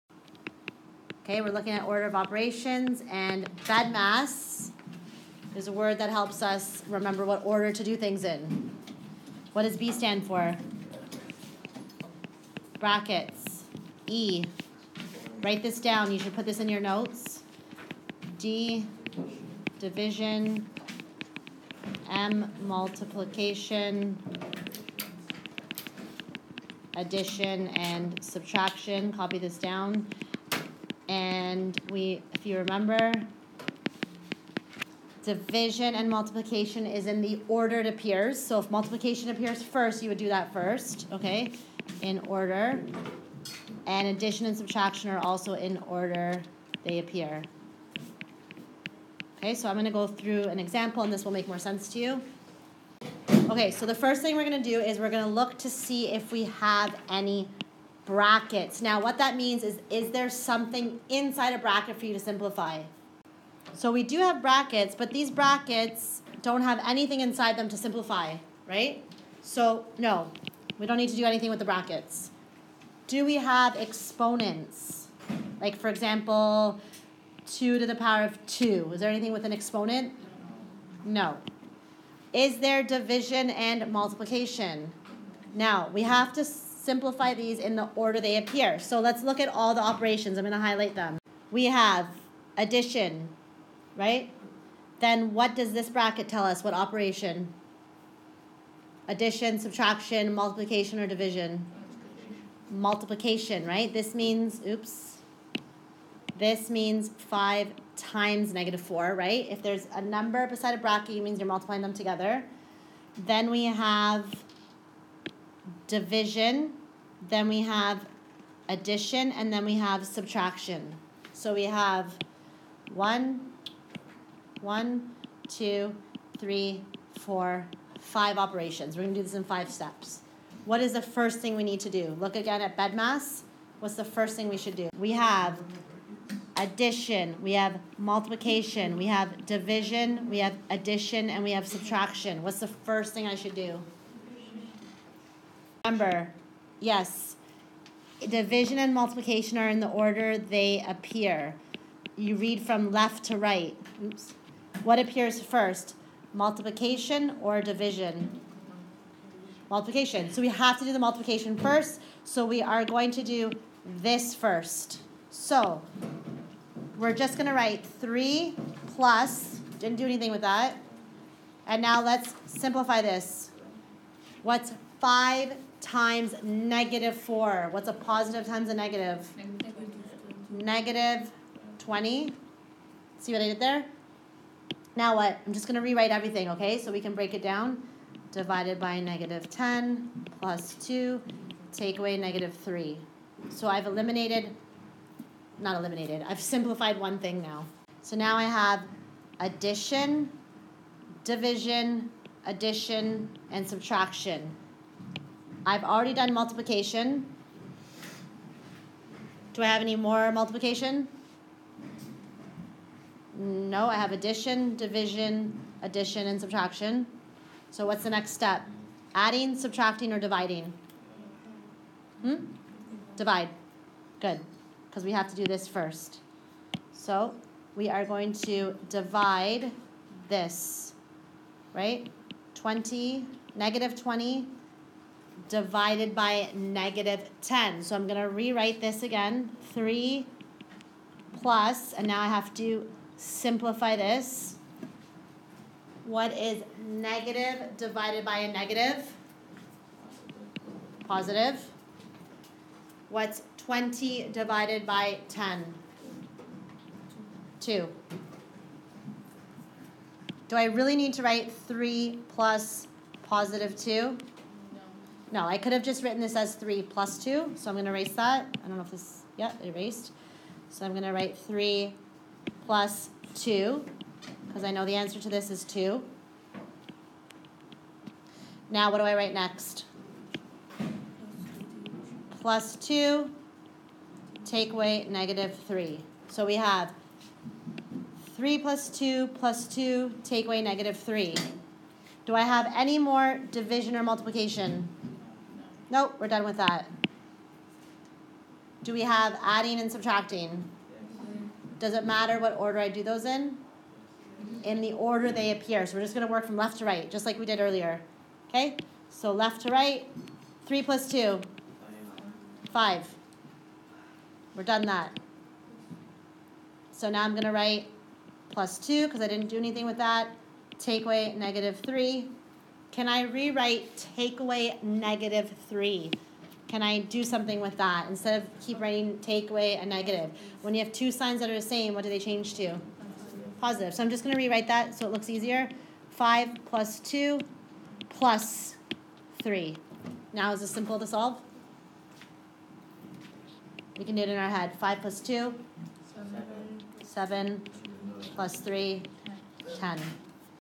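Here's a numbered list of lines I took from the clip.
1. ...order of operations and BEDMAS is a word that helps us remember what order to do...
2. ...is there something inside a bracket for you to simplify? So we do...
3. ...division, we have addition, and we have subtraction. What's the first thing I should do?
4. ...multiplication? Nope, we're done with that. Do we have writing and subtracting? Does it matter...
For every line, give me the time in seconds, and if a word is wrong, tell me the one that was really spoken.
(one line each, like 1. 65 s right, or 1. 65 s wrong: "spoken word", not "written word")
1. 1 s right
2. 59 s right
3. 139 s right
4. 294 s wrong: "adding", not "writing".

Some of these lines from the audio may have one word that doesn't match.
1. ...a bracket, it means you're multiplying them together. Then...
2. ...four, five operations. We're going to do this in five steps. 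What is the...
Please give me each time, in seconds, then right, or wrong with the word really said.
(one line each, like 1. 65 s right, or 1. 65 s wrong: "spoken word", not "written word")
1. 110 s right
2. 127 s right.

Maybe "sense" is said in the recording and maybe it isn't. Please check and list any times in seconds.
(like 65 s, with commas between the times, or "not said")
51 s.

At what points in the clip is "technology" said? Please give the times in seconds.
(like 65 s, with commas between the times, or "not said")
not said.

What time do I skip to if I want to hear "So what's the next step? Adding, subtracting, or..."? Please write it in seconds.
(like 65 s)
217 s.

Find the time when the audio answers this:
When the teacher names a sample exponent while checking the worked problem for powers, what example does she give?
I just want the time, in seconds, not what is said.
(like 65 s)
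77 s.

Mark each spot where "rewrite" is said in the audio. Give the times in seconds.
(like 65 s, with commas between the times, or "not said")
185 s, 238 s, 323 s, 334 s.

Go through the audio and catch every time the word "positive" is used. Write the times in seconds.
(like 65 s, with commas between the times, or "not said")
177 s, 251 s, 263 s, 333 s.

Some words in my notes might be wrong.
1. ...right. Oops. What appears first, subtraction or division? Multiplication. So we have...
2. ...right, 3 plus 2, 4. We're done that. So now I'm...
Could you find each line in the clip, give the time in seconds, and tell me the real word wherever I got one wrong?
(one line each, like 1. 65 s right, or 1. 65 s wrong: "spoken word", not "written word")
1. 153 s wrong: "multiplication", not "subtraction"
2. 309 s wrong: "5", not "4".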